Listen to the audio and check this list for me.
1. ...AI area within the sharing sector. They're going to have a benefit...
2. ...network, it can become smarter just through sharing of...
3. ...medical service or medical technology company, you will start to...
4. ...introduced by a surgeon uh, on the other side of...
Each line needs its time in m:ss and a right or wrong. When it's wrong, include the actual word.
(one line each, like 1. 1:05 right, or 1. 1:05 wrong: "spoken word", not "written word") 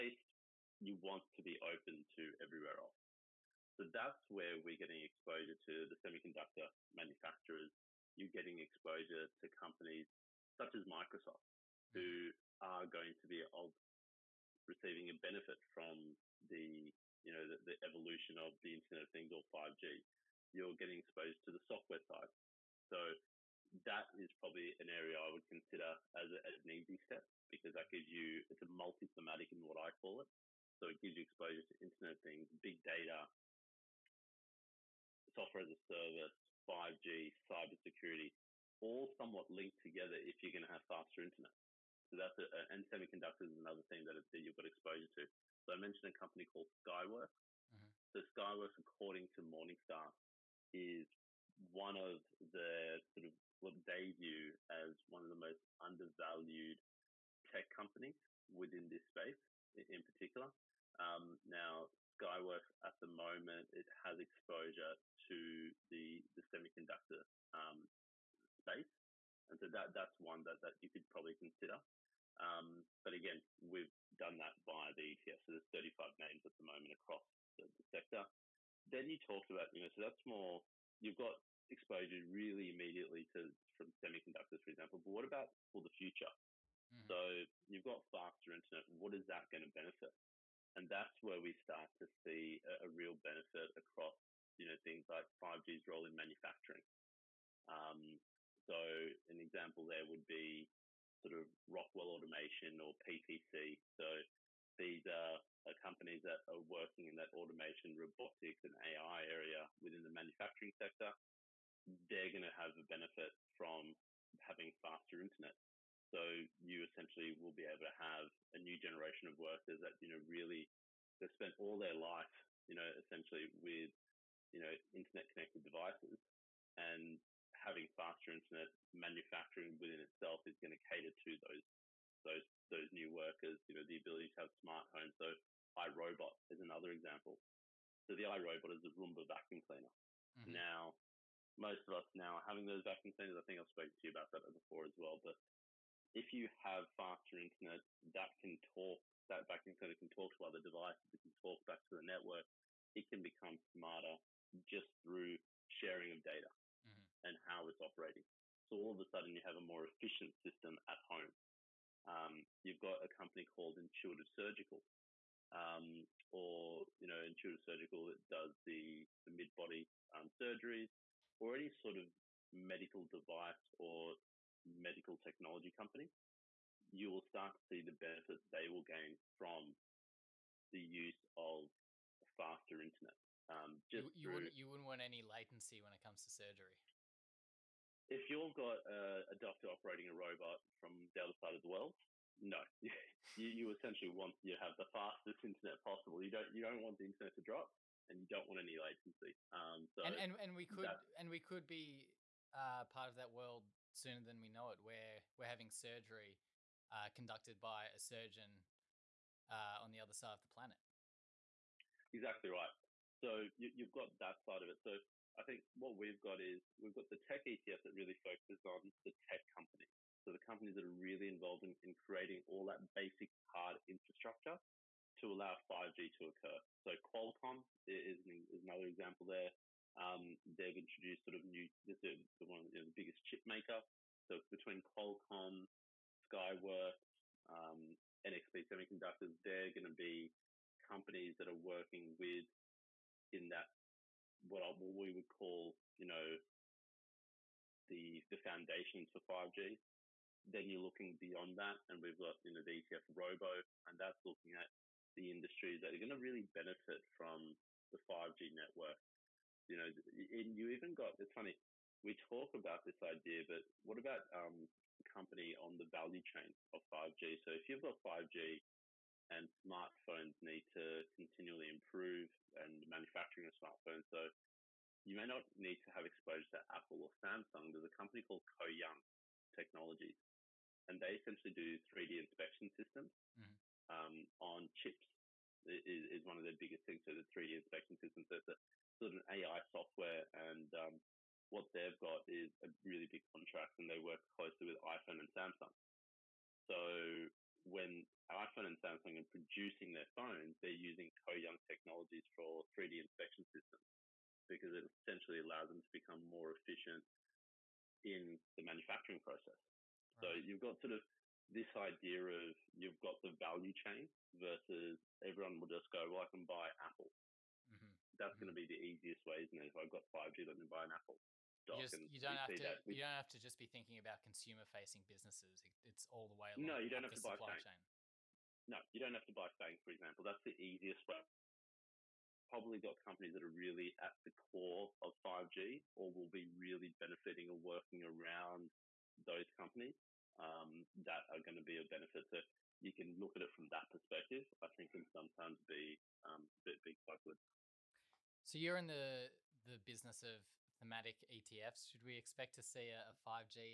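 1. 1:48 wrong: "manufacturing", not "sharing"
2. 2:32 right
3. 2:52 wrong: "device", not "service"
4. 3:27 wrong: "conducted", not "introduced".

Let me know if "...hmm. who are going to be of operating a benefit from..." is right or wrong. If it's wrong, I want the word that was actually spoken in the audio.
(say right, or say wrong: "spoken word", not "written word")
wrong: "receiving", not "operating".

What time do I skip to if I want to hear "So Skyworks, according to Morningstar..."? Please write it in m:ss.
0:48.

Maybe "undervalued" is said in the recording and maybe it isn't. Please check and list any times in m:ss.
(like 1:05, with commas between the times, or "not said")
0:55.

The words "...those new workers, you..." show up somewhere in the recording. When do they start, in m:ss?
2:12.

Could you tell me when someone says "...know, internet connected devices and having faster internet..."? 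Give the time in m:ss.
2:04.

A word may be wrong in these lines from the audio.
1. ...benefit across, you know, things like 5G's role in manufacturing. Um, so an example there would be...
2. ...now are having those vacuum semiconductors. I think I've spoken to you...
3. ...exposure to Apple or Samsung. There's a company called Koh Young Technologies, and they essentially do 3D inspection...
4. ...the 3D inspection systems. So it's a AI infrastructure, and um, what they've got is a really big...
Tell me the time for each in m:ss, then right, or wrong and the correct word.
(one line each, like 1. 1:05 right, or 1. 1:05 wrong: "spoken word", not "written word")
1. 1:33 right
2. 2:22 wrong: "cleaners", not "semiconductors"
3. 4:36 right
4. 4:47 wrong: "software", not "infrastructure".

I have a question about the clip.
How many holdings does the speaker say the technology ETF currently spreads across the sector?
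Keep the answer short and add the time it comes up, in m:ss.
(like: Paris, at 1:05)
35, at 1:15.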